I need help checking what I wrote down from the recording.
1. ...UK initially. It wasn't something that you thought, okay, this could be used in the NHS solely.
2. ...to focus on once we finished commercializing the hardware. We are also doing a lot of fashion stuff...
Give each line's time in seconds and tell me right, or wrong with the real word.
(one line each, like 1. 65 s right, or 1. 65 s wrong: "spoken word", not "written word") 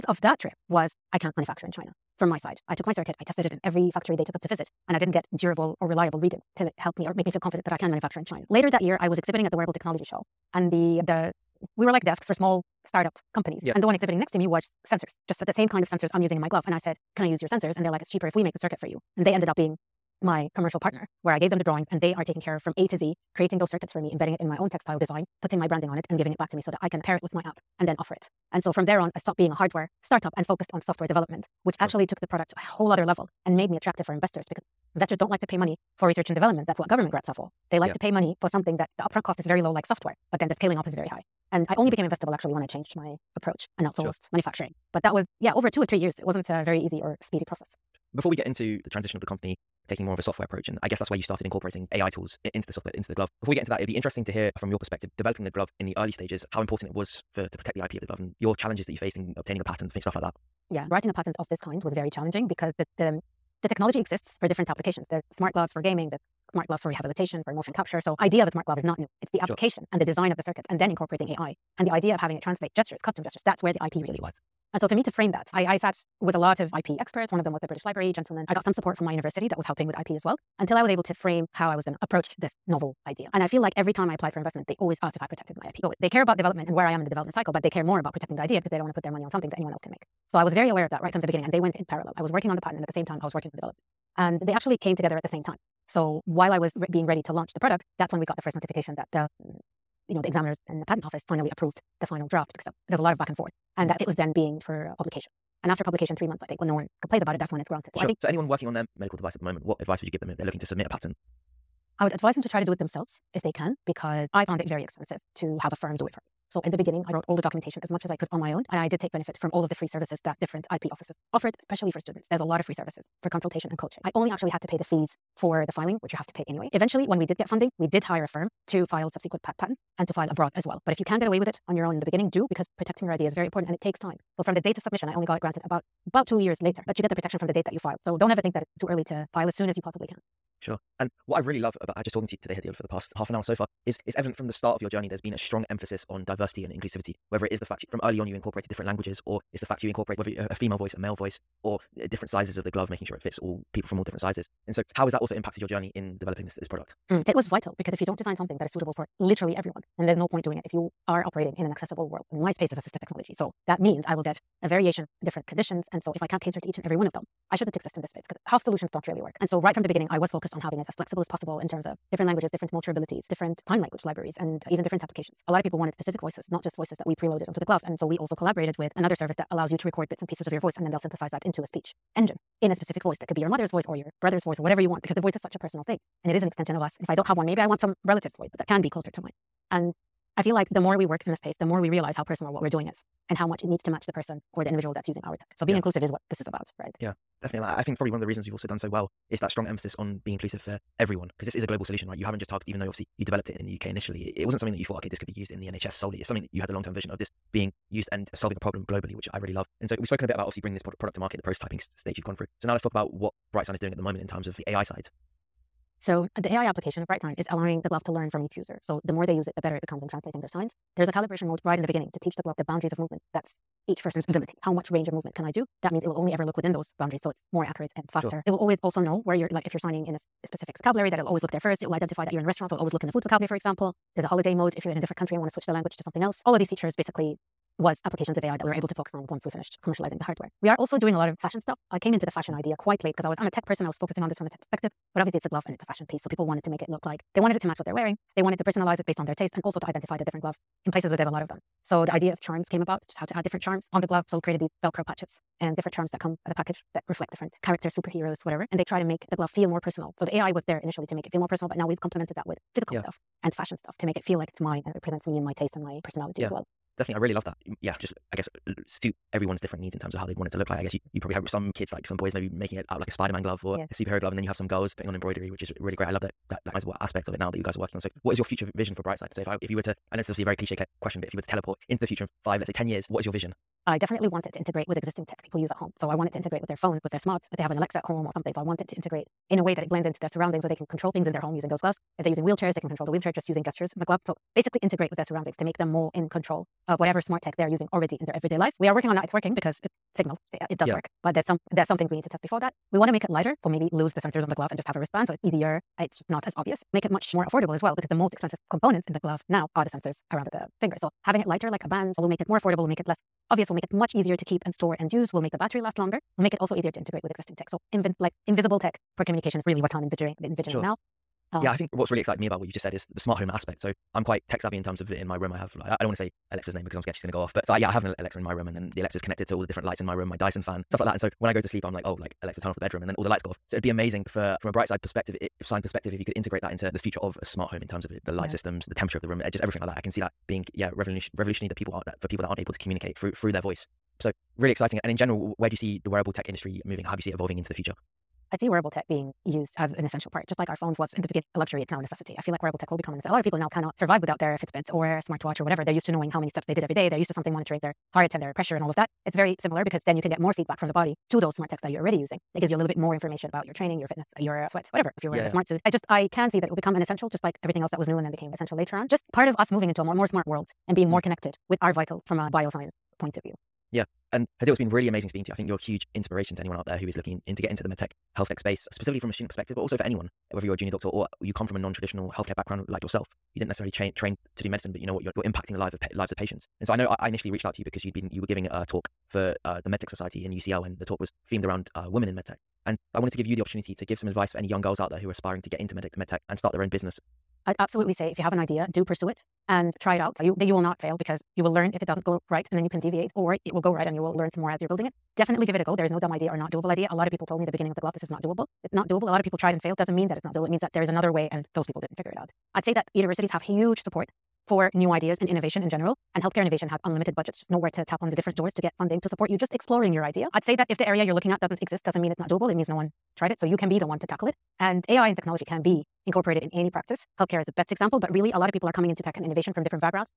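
1. 203 s right
2. 238 s right.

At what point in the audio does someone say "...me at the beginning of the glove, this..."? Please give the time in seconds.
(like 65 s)
407 s.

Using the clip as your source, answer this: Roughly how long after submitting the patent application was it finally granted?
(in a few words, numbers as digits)
2 years.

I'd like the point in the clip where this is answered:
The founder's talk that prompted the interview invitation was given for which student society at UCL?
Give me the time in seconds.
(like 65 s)
389 s.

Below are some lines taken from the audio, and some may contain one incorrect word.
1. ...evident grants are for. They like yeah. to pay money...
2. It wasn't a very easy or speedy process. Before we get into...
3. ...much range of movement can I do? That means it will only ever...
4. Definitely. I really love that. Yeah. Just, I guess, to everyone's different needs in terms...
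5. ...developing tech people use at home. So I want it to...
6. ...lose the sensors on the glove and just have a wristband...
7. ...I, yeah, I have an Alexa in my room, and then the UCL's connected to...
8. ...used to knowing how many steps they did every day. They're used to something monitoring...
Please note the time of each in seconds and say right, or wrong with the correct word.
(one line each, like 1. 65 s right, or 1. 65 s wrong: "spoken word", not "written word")
1. 36 s wrong: "government", not "evident"
2. 46 s right
3. 224 s right
4. 266 s right
5. 284 s wrong: "existing", not "developing"
6. 303 s right
7. 327 s wrong: "Alexa", not "UCL"
8. 355 s right.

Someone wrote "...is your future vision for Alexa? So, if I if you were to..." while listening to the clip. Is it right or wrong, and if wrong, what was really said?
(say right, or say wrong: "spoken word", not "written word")
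wrong: "BrightSign", not "Alexa".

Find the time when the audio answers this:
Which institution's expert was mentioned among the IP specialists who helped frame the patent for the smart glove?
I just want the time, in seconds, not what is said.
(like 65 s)
77 s.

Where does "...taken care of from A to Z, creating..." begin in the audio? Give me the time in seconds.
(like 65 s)
22 s.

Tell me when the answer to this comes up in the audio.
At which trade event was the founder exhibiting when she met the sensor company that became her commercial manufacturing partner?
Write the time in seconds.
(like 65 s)
9 s.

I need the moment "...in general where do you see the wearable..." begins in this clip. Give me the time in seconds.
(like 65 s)
345 s.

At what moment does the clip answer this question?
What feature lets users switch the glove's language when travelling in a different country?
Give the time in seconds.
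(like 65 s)
234 s.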